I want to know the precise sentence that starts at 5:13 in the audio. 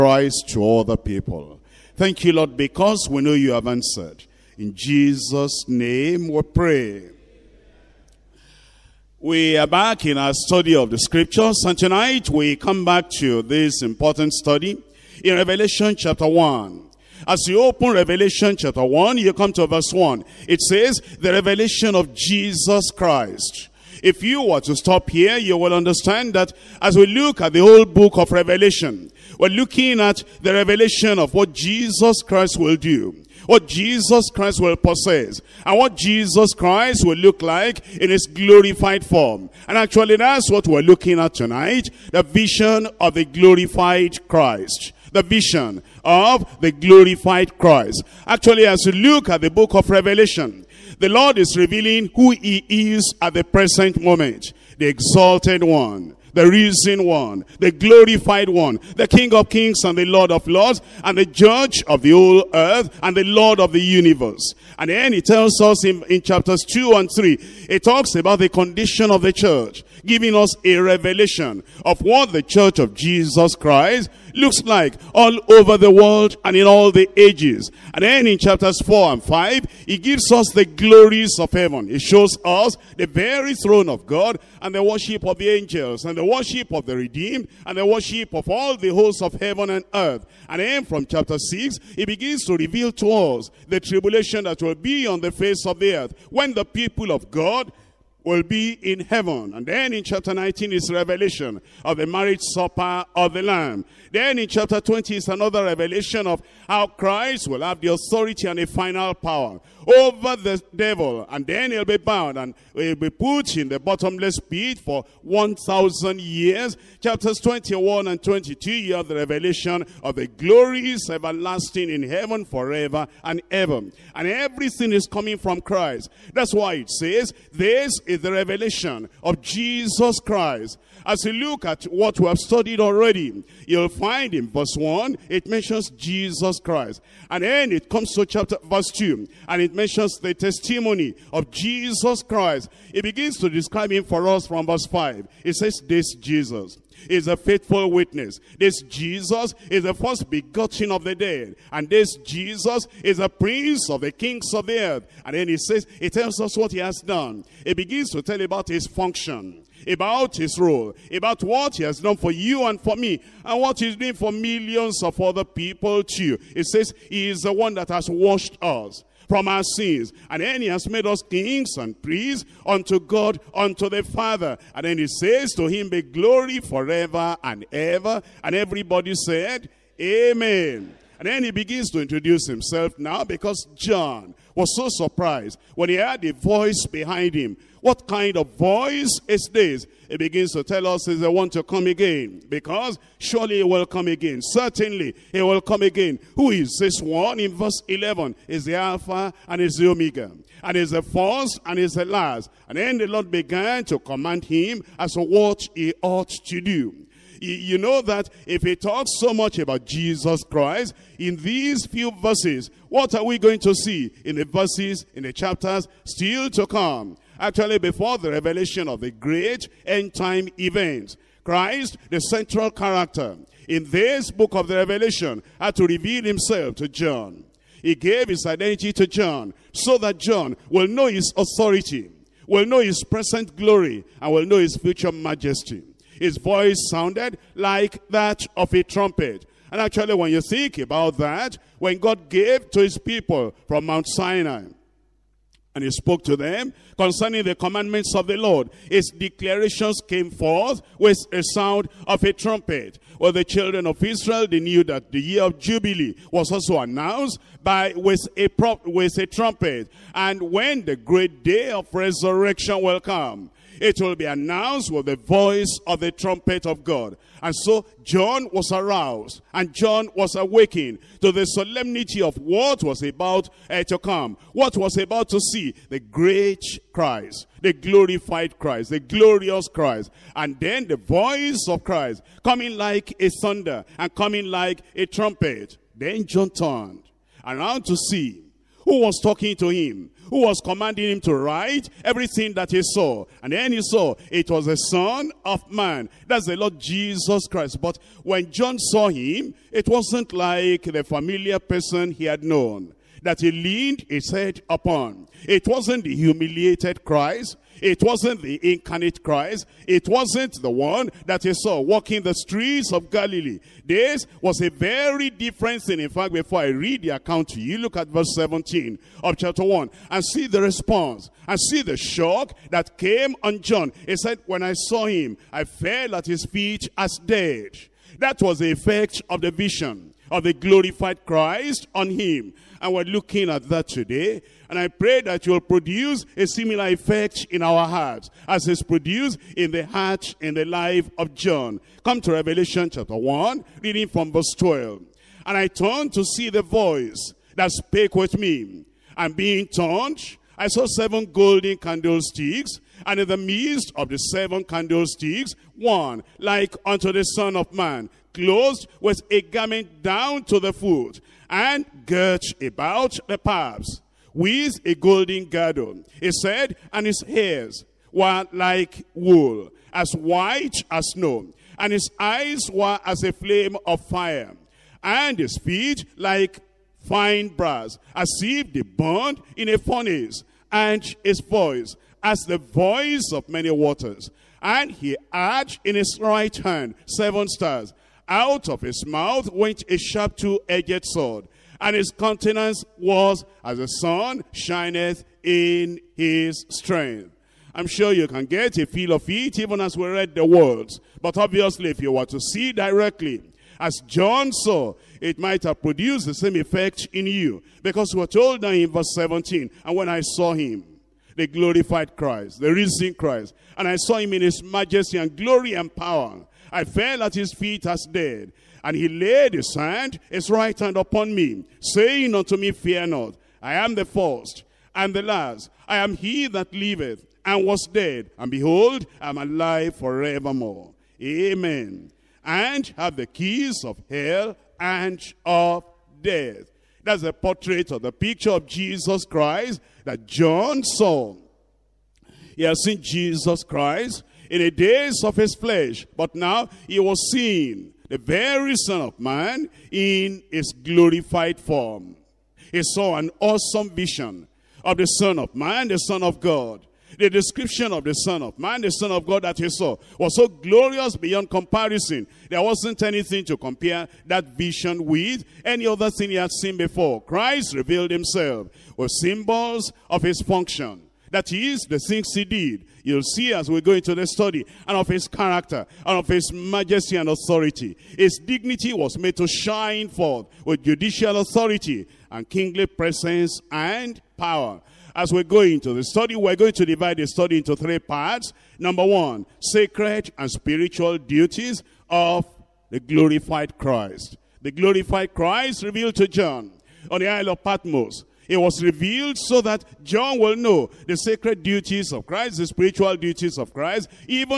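This was a very different thing.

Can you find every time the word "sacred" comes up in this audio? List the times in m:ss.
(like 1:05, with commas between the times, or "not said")
8:09, 8:21.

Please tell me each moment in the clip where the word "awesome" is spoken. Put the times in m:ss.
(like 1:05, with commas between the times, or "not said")
7:33.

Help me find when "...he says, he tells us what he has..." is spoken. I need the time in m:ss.
2:35.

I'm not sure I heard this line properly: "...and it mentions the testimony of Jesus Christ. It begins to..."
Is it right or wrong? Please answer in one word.
right.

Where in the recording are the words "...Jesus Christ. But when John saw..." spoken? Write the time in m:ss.
4:56.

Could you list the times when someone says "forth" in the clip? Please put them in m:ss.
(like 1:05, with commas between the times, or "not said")
4:10, 8:00.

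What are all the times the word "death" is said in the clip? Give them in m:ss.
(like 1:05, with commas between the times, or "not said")
7:16.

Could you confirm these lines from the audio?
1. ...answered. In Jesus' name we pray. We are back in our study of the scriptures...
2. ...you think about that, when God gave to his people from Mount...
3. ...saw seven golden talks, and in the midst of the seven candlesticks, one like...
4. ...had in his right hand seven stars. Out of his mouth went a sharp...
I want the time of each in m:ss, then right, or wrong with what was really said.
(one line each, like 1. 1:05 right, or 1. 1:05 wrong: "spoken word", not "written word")
1. 0:03 right
2. 4:00 right
3. 5:50 wrong: "candlesticks", not "talks"
4. 6:25 right.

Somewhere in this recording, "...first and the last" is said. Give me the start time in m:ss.
7:04.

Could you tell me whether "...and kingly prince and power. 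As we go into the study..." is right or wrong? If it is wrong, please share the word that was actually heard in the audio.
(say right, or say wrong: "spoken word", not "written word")
wrong: "presence", not "prince".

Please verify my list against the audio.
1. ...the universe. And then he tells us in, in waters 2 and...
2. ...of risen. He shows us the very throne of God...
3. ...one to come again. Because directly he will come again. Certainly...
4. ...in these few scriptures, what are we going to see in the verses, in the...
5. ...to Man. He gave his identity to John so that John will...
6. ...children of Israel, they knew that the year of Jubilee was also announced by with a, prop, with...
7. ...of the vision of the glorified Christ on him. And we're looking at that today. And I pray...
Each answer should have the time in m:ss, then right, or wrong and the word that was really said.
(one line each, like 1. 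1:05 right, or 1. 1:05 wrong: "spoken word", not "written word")
1. 1:03 wrong: "chapters", not "waters"
2. 1:21 wrong: "heaven", not "risen"
3. 3:11 wrong: "surely", not "directly"
4. 3:31 wrong: "verses", not "scriptures"
5. 3:46 wrong: "John", not "Man"
6. 4:13 right
7. 5:29 right.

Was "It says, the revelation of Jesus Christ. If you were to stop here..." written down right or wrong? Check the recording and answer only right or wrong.
right.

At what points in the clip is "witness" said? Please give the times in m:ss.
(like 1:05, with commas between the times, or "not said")
2:27.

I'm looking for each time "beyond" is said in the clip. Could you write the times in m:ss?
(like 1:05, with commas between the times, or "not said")
7:41.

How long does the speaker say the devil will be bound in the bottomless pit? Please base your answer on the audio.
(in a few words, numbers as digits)
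1,000 years.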